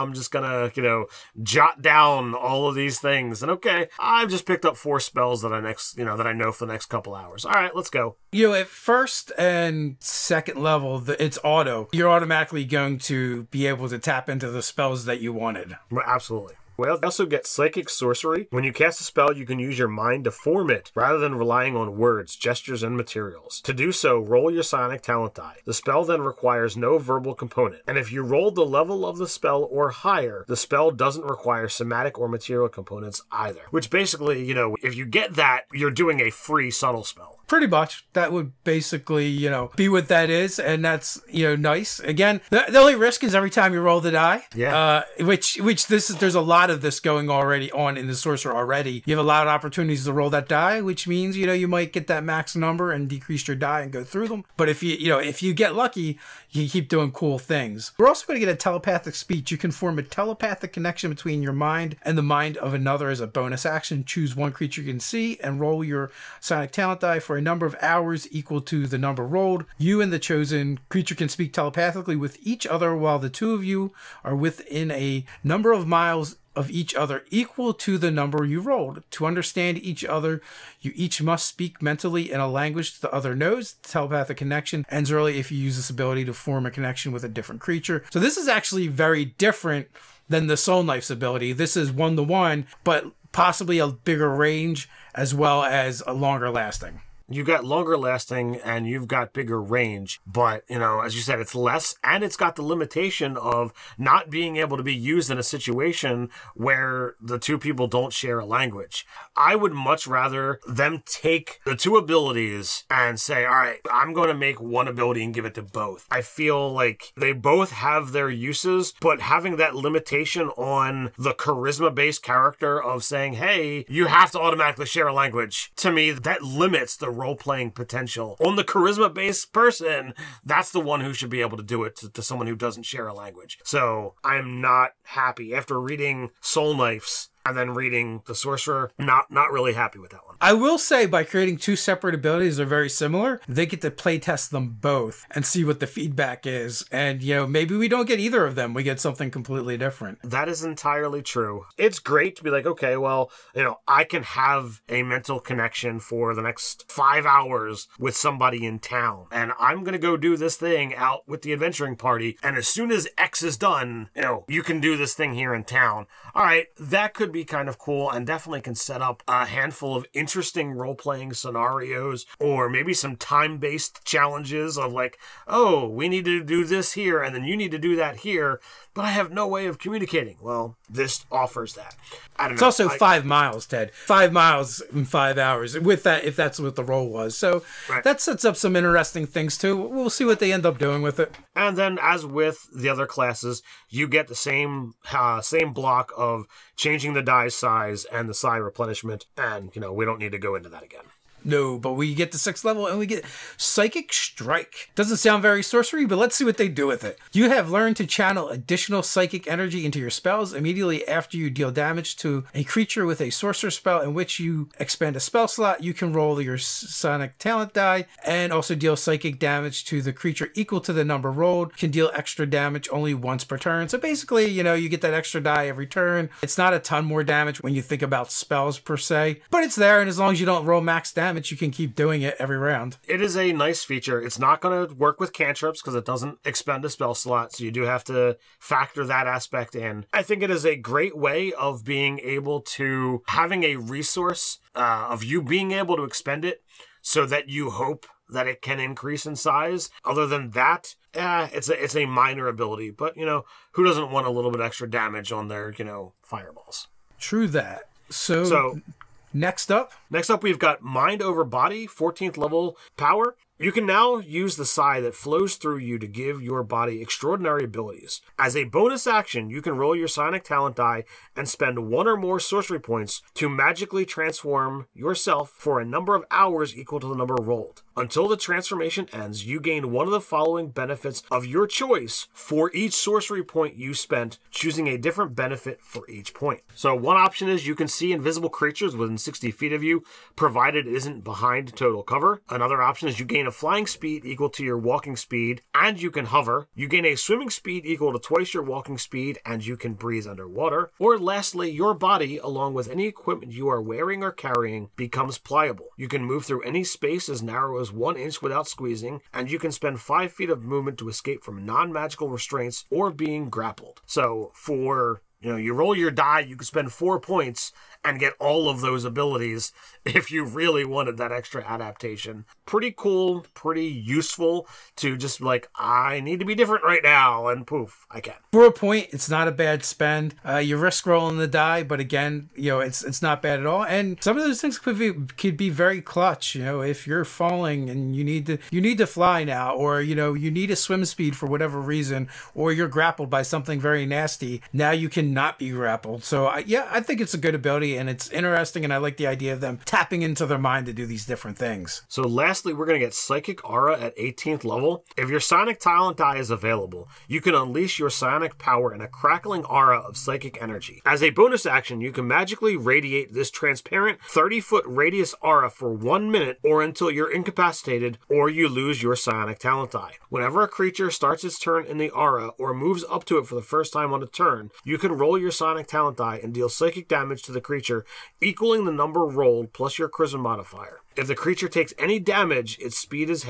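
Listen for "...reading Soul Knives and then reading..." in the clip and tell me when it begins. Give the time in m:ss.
2:15.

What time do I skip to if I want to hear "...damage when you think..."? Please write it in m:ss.
3:47.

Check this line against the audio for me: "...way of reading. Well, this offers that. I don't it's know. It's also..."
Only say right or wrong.
wrong.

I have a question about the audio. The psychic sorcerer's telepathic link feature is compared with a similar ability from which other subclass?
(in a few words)
Soul Knife.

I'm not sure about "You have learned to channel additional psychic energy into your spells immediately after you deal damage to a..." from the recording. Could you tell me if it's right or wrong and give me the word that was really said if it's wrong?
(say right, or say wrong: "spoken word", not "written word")
right.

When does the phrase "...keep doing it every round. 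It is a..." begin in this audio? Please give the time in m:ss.
3:51.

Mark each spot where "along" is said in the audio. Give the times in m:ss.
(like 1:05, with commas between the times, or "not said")
5:02.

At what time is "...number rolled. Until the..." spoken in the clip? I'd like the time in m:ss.
4:37.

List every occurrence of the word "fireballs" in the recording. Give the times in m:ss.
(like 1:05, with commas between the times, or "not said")
4:16.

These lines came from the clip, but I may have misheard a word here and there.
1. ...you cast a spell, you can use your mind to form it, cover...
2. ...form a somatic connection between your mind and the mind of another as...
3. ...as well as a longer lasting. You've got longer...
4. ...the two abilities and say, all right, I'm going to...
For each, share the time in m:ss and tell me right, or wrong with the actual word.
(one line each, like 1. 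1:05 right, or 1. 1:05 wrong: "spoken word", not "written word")
1. 0:18 wrong: "rather", not "cover"
2. 0:59 wrong: "telepathic", not "somatic"
3. 1:35 right
4. 1:51 right.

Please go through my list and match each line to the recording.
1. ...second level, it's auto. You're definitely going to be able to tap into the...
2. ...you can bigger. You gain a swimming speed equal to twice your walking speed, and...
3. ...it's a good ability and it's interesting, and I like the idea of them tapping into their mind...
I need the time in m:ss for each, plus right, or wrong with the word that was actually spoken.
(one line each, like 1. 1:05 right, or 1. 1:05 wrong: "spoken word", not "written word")
1. 0:09 wrong: "automatically", not "definitely"
2. 4:56 wrong: "hover", not "bigger"
3. 5:47 right.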